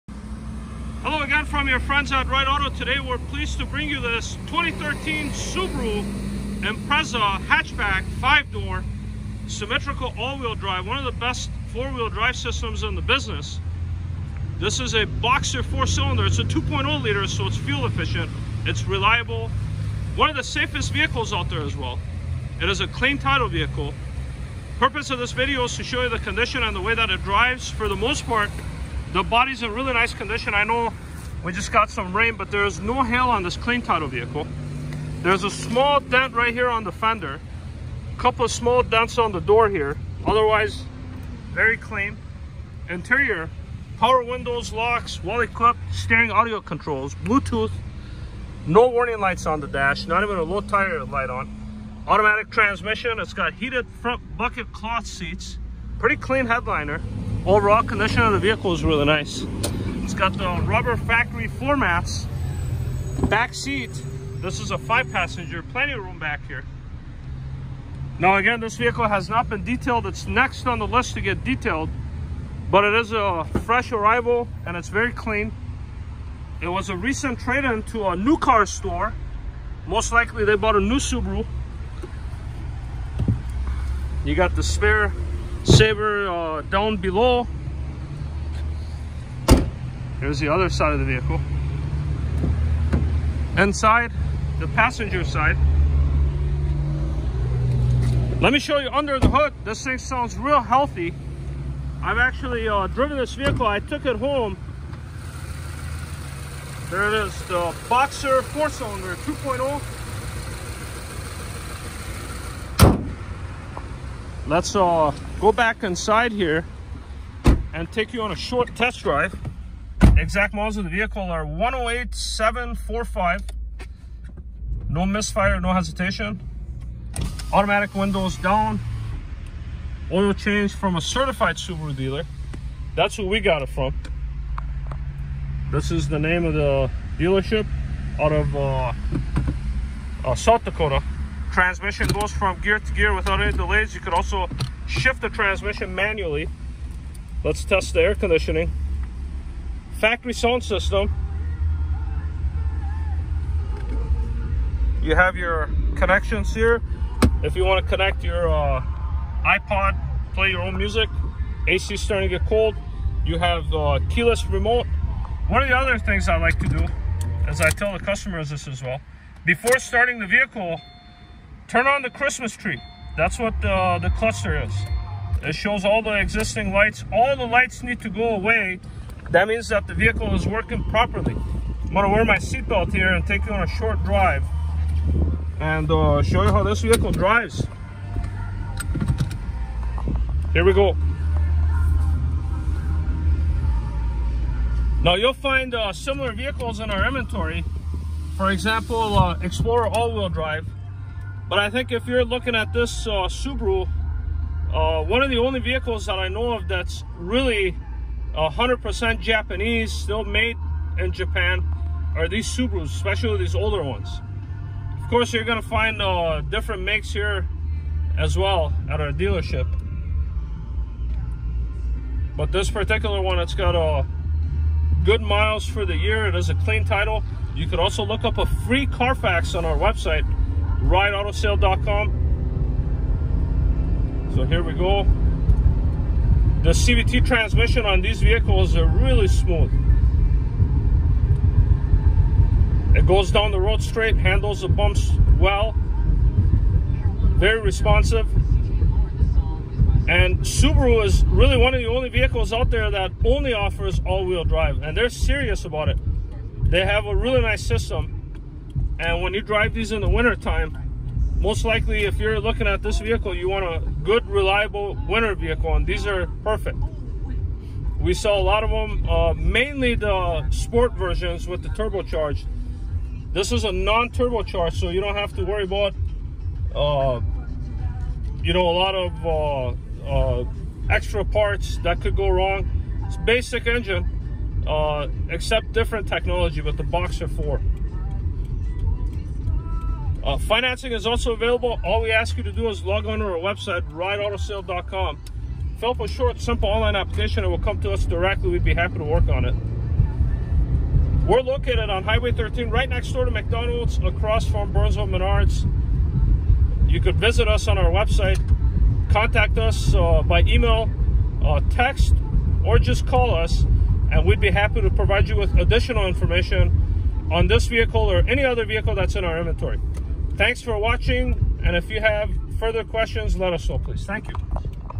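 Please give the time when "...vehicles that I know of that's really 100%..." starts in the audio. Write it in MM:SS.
03:25.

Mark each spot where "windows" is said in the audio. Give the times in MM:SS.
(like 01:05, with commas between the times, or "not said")
00:44, 02:07.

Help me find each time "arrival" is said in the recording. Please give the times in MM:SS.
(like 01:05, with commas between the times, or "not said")
01:13.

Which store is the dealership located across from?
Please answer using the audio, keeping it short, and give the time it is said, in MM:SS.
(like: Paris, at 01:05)
Burnsville Menards, at 05:04.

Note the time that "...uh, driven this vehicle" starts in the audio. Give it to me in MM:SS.
01:42.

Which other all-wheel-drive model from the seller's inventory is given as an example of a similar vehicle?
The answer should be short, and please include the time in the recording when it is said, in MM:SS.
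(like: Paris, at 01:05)
Explorer, at 03:19.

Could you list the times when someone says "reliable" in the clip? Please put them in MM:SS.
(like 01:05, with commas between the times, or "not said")
00:18, 04:24.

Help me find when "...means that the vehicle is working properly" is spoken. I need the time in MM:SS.
02:59.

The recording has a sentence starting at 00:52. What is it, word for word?
Automatic transmission, it's got heated front bucket cloth seats, pretty clean headliner.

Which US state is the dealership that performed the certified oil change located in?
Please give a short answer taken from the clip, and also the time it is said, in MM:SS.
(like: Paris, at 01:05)
South Dakota, at 02:20.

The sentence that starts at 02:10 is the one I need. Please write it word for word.
Oil change from a certified Subaru dealer.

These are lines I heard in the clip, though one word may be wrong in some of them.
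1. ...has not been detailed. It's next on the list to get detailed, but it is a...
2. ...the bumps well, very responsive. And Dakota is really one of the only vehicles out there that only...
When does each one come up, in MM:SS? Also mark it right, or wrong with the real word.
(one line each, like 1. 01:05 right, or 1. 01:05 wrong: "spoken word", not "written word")
1. 01:09 right
2. 04:04 wrong: "Subaru", not "Dakota".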